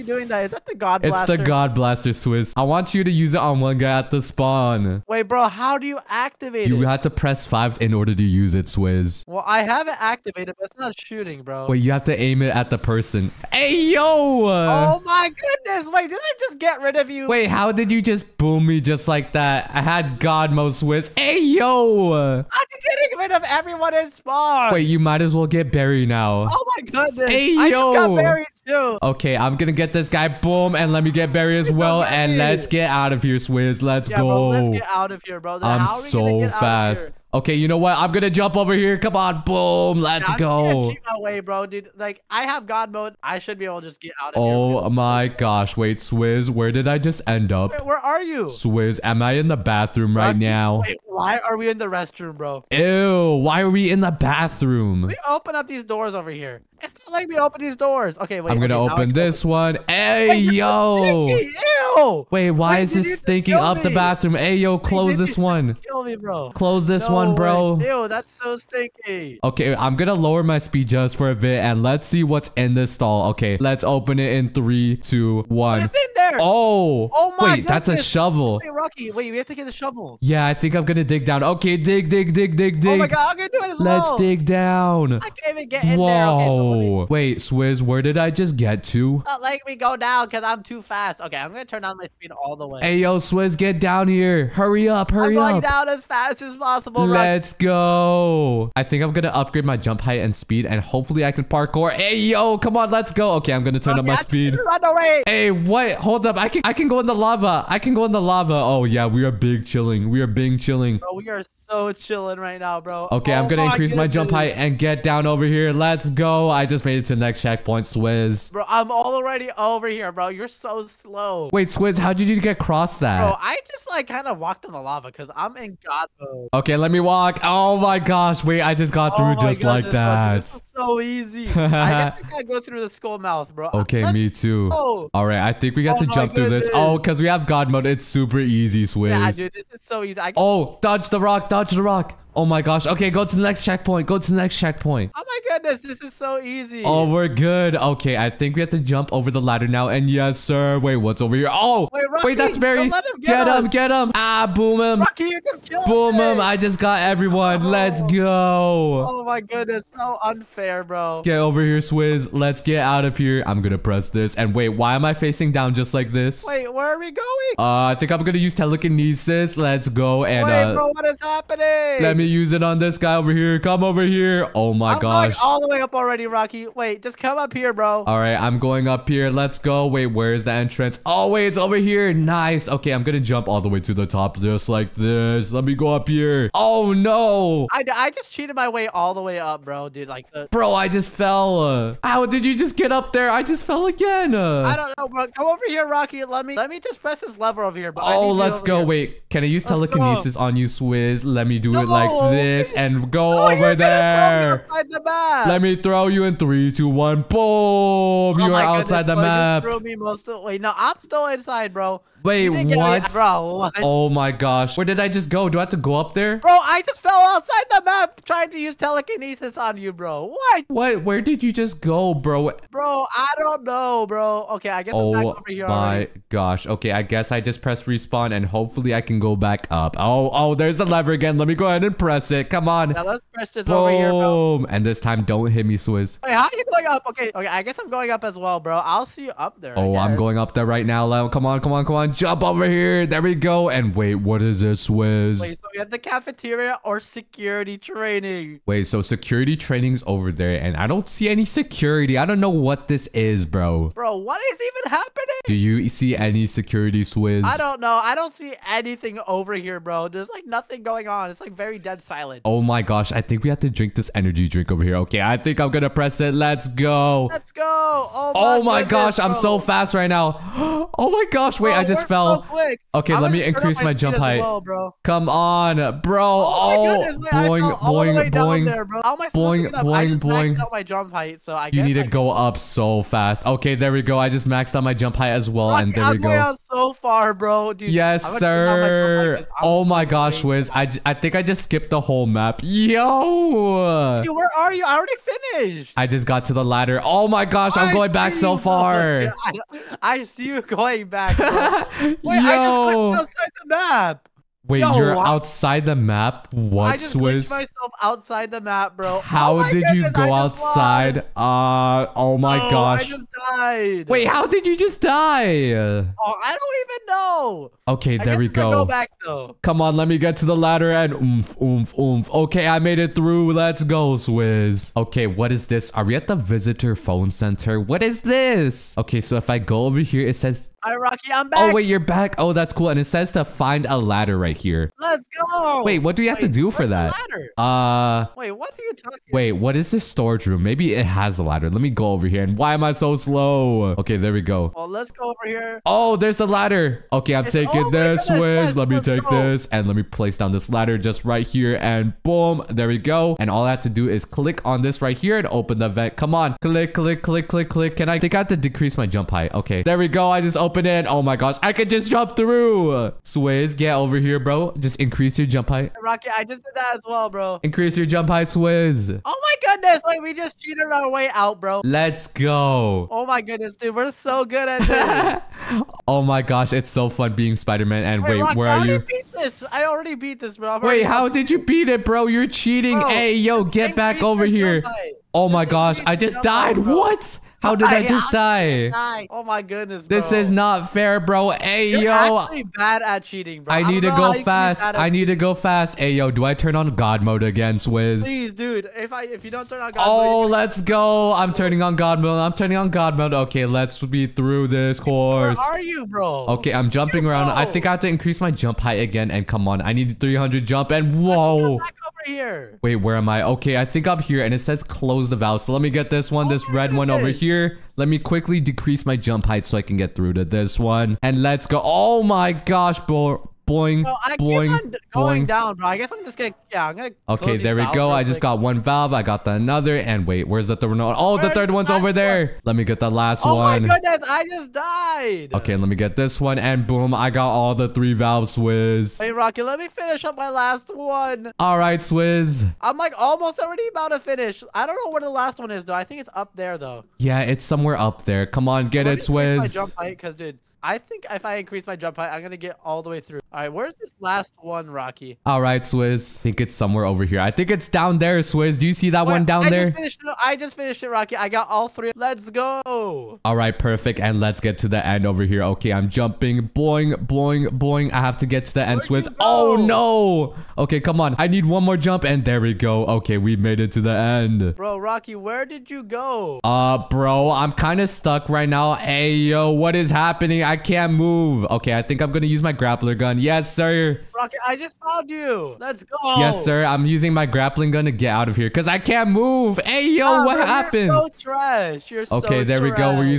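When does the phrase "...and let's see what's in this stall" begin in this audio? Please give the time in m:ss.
1:11.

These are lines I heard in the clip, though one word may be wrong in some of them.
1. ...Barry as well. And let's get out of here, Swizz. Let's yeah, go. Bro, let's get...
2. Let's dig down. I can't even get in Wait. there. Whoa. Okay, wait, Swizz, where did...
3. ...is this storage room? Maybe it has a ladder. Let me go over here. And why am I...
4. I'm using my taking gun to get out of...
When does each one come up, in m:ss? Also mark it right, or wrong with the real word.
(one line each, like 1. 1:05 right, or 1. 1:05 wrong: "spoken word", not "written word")
1. 0:31 right
2. 1:24 wrong: "Whoa", not "Wait"
3. 5:39 right
4. 8:06 wrong: "grappling", not "taking".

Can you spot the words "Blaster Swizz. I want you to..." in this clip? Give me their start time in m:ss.
0:01.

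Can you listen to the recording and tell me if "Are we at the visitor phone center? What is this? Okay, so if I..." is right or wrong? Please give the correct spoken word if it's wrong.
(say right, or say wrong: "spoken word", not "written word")
right.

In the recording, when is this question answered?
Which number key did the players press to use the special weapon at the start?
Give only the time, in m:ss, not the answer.
0:07.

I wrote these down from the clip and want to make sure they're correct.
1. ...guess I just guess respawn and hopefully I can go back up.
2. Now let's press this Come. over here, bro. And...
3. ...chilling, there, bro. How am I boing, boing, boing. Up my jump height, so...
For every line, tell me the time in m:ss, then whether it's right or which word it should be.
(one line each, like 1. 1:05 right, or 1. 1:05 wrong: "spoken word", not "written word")
1. 3:47 wrong: "press", not "guess"
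2. 3:52 wrong: "Boom", not "Come"
3. 4:38 wrong: "boing", not "chilling".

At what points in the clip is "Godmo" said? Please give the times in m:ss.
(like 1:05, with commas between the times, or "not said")
0:20.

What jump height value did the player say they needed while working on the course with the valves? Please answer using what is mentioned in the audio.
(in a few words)
300.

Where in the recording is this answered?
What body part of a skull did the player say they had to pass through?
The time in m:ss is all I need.
2:12.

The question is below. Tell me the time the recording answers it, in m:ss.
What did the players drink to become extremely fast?
4:24.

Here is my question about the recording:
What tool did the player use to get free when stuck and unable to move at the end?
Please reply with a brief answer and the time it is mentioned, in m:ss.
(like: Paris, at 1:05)
grappling gun, at 8:02.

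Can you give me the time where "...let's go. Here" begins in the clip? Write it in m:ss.
3:18.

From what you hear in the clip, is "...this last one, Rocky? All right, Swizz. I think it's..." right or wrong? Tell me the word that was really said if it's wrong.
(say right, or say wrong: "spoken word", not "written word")
right.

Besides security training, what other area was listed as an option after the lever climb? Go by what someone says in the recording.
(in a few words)
cafeteria.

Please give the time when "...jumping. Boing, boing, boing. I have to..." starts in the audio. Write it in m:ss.
7:46.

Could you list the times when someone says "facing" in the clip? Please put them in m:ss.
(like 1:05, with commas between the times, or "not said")
2:45.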